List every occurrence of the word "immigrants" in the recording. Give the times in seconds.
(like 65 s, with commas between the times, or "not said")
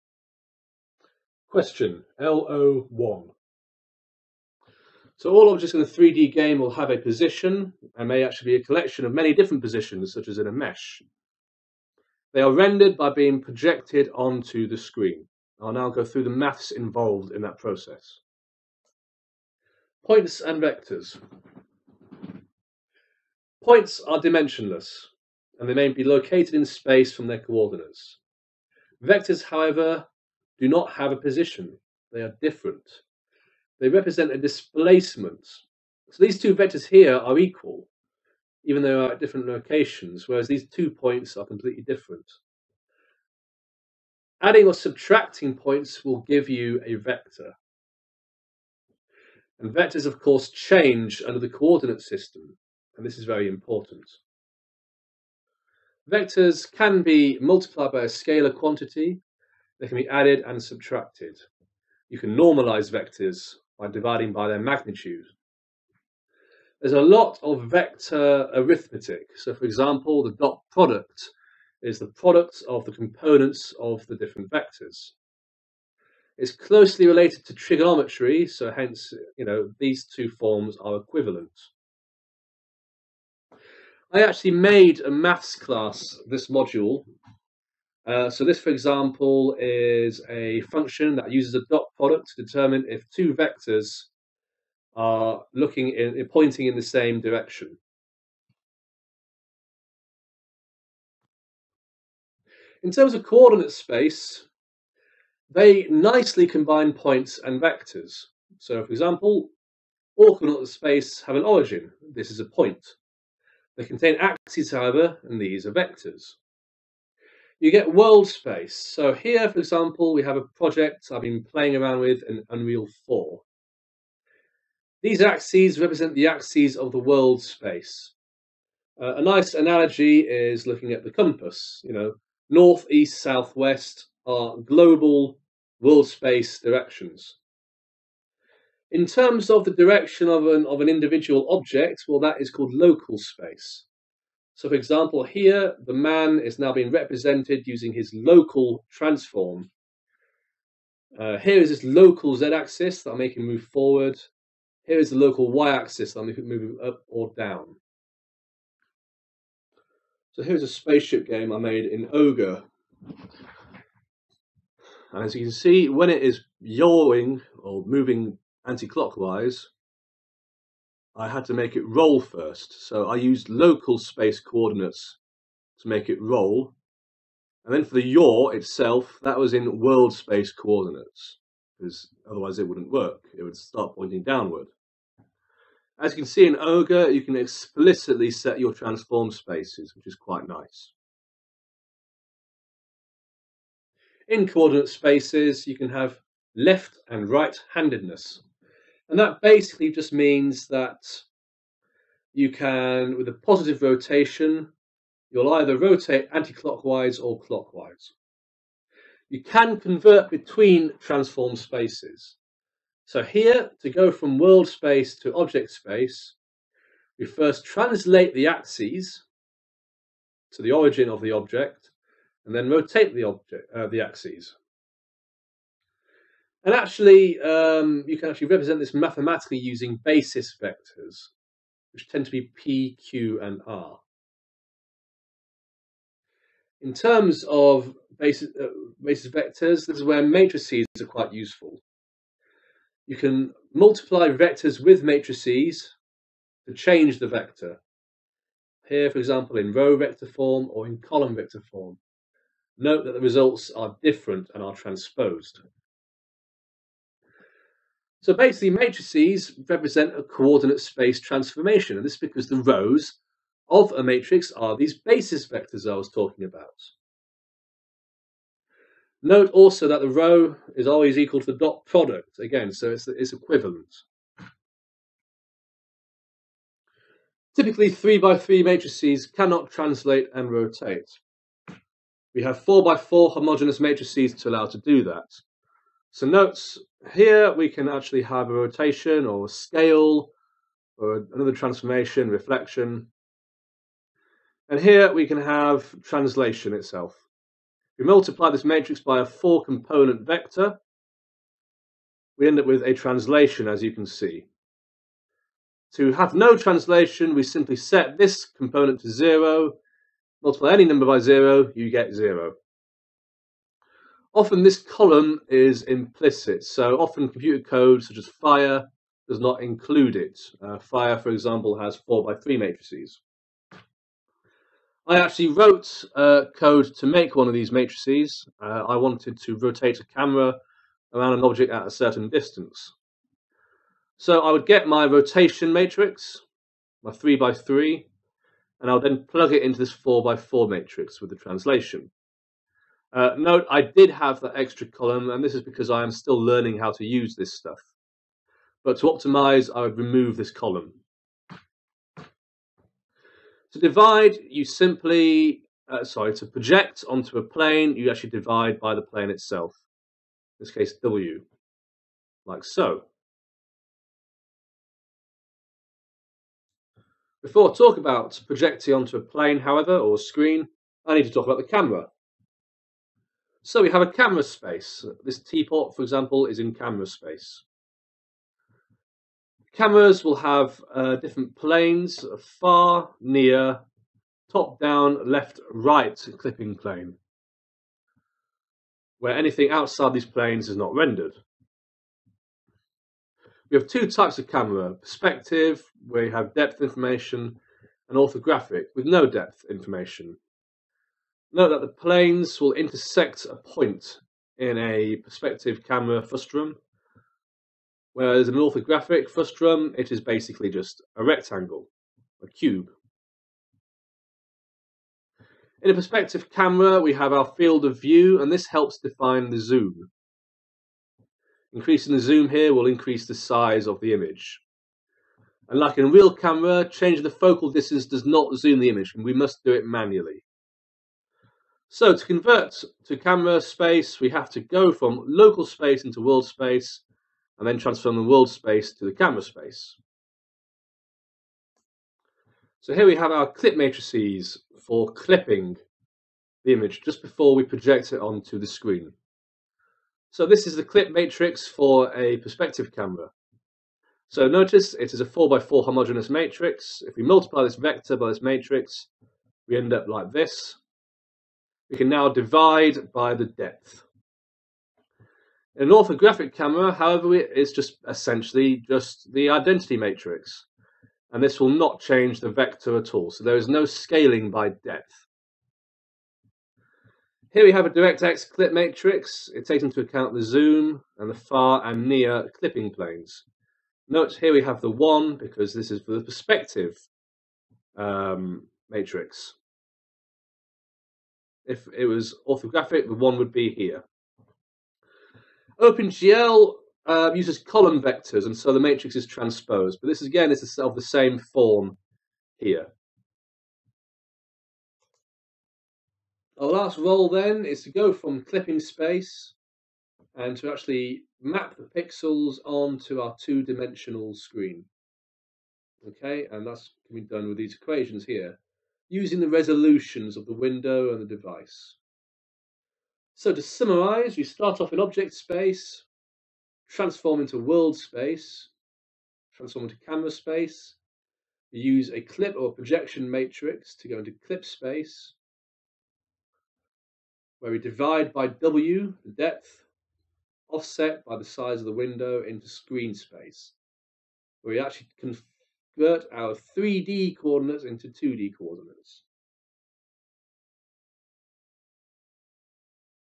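not said.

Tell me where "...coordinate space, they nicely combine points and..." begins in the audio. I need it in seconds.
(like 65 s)
103 s.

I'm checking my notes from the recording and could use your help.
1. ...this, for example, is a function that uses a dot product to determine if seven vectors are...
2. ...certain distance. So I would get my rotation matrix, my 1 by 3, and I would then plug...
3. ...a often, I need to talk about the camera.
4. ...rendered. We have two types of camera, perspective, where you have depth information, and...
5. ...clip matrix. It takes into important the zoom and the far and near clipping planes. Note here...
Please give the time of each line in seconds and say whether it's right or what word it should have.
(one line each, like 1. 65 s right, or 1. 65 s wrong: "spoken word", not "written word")
1. 88 s wrong: "two", not "seven"
2. 331 s wrong: "3", not "1"
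3. 370 s wrong: "screen", not "often"
4. 390 s right
5. 478 s wrong: "account", not "important".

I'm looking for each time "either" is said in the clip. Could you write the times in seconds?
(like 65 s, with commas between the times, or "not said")
205 s.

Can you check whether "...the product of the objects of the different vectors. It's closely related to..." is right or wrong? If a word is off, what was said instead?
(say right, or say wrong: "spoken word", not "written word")
wrong: "components", not "objects".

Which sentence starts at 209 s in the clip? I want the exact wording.
You can convert between transform spaces.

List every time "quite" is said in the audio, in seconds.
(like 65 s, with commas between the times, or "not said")
190 s, 241 s.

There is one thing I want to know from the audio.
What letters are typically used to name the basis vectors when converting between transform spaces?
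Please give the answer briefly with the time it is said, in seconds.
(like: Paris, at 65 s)
p, q, and r, at 232 s.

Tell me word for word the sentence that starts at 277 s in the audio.
Typically, 3 by 3 matrices cannot translate and rotate.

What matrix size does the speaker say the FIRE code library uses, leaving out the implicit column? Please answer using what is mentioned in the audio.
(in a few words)
4 by 3.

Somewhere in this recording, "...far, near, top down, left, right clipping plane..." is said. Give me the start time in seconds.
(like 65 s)
382 s.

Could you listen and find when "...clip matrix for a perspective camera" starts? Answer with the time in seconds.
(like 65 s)
450 s.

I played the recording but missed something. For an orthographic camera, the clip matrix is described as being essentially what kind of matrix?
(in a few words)
identity matrix.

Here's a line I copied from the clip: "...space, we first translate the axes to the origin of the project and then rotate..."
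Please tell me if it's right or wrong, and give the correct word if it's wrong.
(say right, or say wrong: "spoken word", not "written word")
wrong: "object", not "project".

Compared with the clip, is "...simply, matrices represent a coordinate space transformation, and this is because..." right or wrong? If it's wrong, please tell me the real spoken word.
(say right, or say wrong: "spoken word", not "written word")
wrong: "basically", not "simply".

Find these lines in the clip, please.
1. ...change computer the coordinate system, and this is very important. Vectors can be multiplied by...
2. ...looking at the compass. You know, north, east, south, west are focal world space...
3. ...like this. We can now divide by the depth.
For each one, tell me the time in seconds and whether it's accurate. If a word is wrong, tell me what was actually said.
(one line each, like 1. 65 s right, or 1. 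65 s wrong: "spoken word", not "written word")
1. 50 s wrong: "under", not "computer"
2. 130 s wrong: "global", not "focal"
3. 460 s right.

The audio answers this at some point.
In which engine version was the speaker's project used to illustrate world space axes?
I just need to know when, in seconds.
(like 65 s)
122 s.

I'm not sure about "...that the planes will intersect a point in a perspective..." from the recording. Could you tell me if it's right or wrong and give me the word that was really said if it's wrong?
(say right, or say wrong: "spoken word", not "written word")
right.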